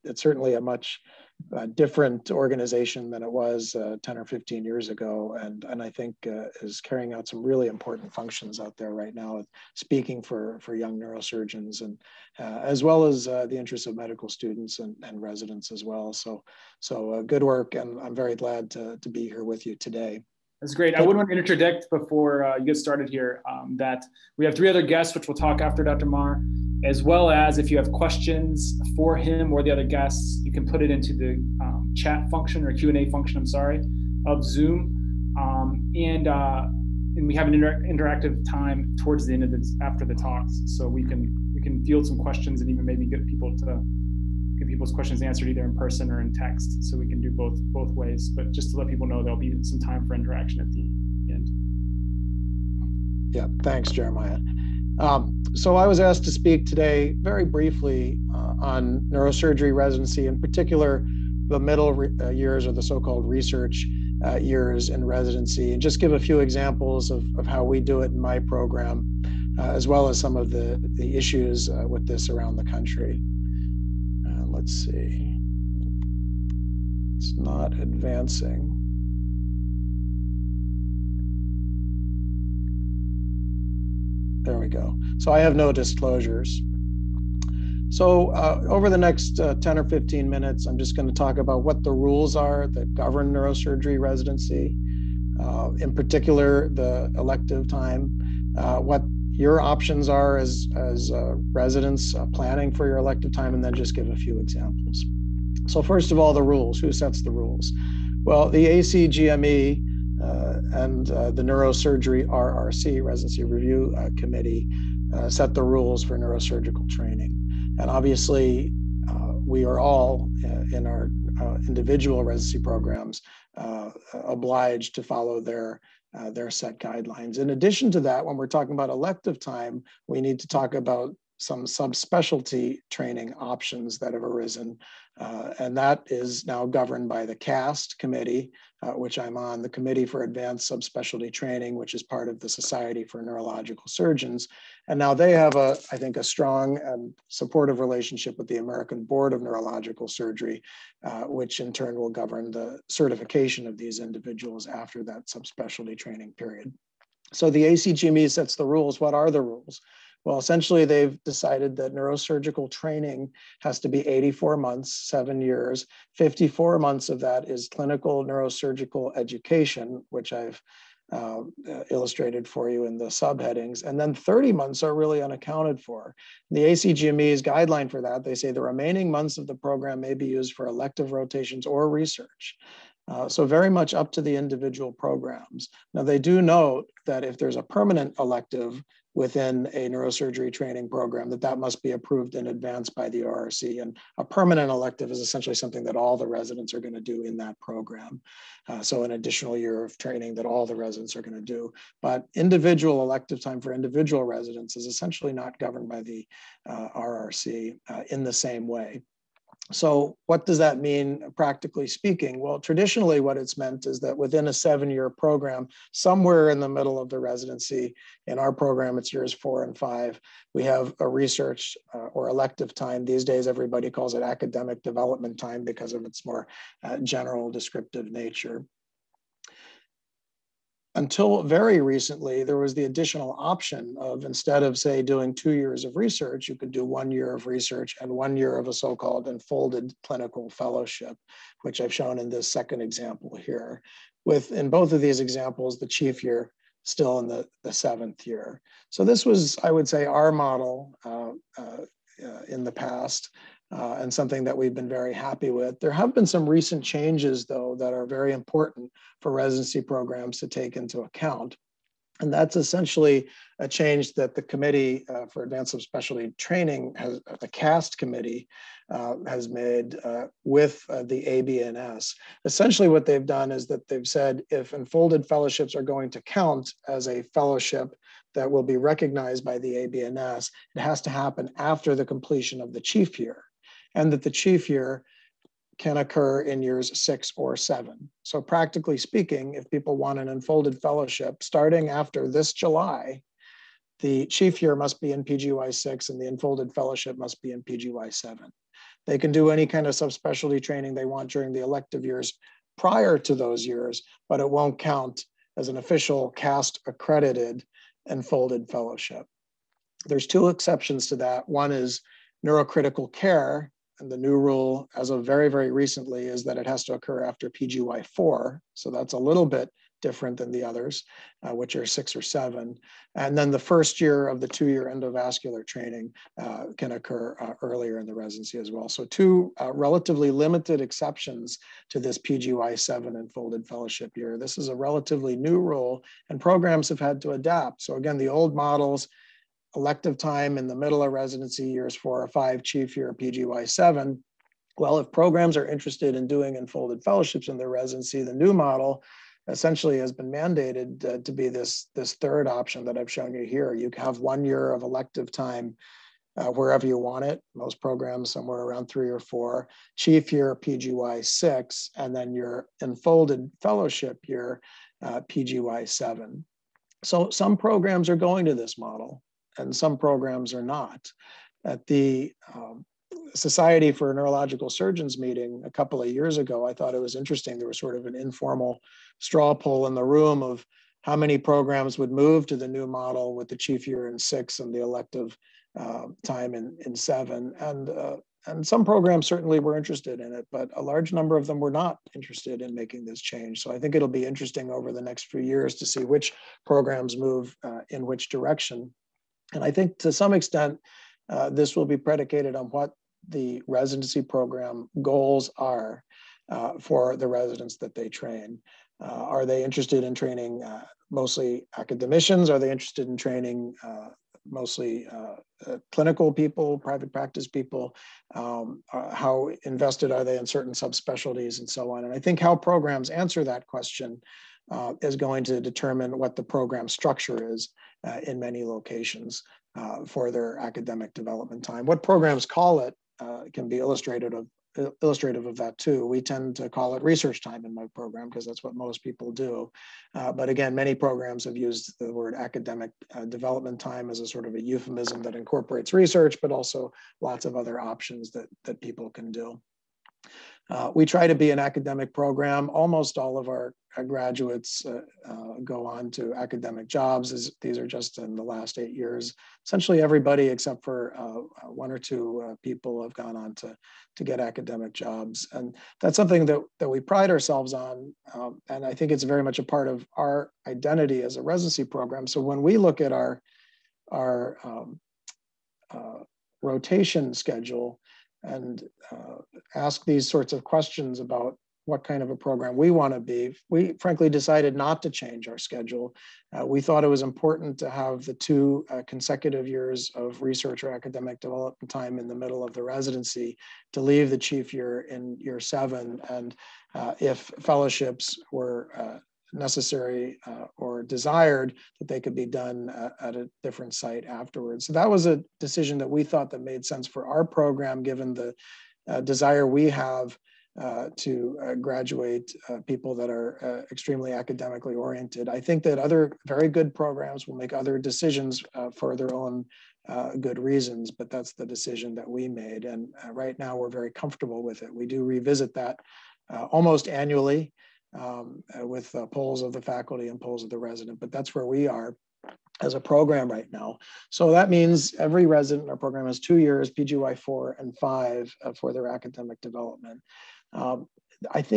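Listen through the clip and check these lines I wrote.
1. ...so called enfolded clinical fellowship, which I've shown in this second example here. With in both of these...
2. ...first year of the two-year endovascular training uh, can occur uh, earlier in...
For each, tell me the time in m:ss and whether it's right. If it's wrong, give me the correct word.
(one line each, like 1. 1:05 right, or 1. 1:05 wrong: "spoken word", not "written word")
1. 3:58 right
2. 5:23 right.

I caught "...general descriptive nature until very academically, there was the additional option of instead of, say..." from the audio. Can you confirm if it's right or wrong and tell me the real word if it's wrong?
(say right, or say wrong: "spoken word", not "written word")
wrong: "recently", not "academically".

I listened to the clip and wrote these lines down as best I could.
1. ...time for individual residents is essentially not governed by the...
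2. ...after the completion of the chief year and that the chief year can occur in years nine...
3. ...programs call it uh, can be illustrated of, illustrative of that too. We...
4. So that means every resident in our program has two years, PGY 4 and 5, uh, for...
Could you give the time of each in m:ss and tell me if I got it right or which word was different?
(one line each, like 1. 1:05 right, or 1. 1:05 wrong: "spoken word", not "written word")
1. 3:23 right
2. 4:41 wrong: "six", not "nine"
3. 7:12 right
4. 8:54 right.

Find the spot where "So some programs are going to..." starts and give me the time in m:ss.
6:07.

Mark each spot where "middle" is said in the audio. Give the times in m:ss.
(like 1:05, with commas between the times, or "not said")
1:01, 3:36, 5:40, 8:12.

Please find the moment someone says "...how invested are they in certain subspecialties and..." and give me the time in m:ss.
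6:58.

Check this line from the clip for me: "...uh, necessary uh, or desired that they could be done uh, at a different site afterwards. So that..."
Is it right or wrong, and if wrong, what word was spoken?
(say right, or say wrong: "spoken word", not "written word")
right.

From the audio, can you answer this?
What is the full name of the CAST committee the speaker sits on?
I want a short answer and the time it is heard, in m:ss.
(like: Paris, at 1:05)
Committee for Advanced Subspecialty Training, at 2:19.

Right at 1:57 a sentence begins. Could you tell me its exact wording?
And obviously, uh, we are all uh, in our uh, individual residency programs obliged to follow their their set guidelines.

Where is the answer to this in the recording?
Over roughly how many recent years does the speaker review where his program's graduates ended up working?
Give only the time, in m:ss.
7:38.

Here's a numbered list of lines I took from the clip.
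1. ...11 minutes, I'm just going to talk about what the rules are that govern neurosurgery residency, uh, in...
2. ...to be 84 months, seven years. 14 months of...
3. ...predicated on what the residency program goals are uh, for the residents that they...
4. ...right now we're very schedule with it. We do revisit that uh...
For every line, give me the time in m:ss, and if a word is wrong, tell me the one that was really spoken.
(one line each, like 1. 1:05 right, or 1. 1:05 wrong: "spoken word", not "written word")
1. 1:29 wrong: "15", not "11"
2. 2:43 wrong: "54", not "14"
3. 6:41 right
4. 8:43 wrong: "comfortable", not "schedule".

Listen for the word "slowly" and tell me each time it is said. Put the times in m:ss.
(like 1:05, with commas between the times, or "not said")
not said.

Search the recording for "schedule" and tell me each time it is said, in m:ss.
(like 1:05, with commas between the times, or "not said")
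7:57, 8:05.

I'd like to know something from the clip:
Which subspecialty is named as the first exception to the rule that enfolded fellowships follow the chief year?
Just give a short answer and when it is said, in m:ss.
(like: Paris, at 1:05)
Neurocritical care, at 5:12.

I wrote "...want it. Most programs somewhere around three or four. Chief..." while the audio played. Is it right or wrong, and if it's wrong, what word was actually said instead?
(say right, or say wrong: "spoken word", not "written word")
right.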